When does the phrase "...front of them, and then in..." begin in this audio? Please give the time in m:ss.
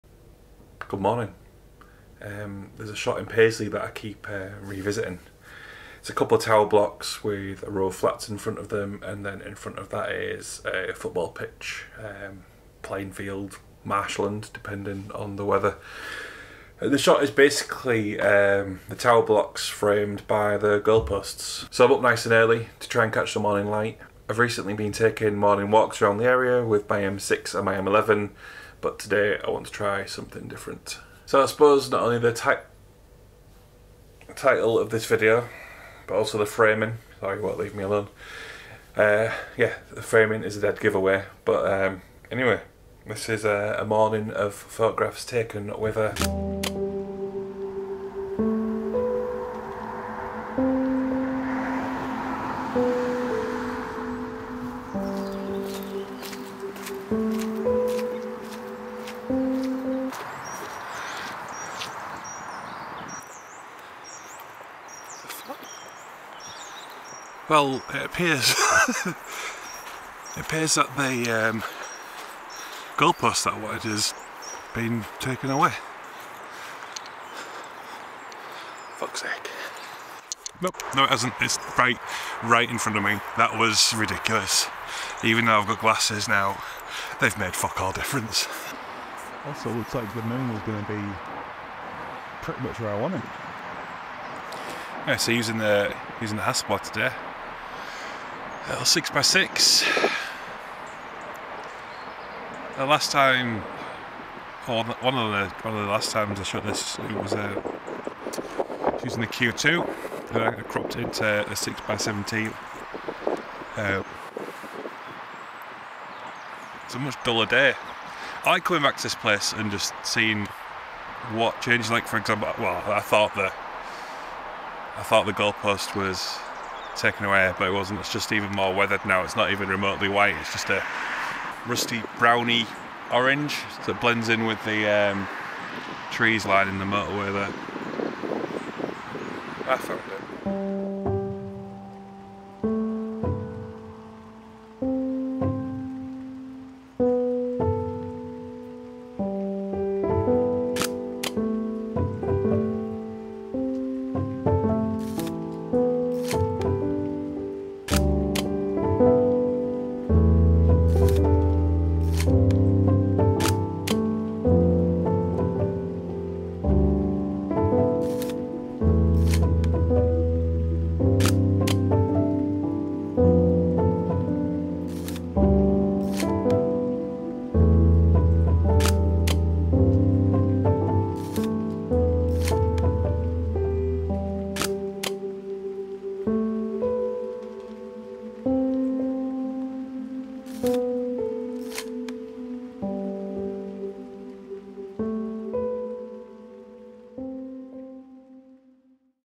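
0:08.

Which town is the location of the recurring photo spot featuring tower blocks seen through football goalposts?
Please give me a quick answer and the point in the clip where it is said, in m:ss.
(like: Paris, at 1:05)
Paisley, at 0:03.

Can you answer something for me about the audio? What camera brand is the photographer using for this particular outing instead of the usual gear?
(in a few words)
Hasselblad.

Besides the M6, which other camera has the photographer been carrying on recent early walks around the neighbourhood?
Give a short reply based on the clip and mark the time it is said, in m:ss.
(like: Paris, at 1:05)
M11, at 0:27.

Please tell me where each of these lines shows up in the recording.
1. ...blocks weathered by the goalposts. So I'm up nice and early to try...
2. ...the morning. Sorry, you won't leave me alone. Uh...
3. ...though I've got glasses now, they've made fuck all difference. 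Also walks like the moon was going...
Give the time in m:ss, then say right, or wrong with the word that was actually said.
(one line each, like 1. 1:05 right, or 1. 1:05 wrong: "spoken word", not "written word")
1. 0:19 wrong: "framed", not "weathered"
2. 0:36 wrong: "framing", not "morning"
3. 1:25 wrong: "looks", not "walks".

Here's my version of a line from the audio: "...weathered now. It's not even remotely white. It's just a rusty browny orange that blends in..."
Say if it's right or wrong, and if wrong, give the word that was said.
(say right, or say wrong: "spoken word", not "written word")
right.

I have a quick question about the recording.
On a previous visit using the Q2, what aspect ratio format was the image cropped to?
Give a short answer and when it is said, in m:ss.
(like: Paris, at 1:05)
6x17, at 1:51.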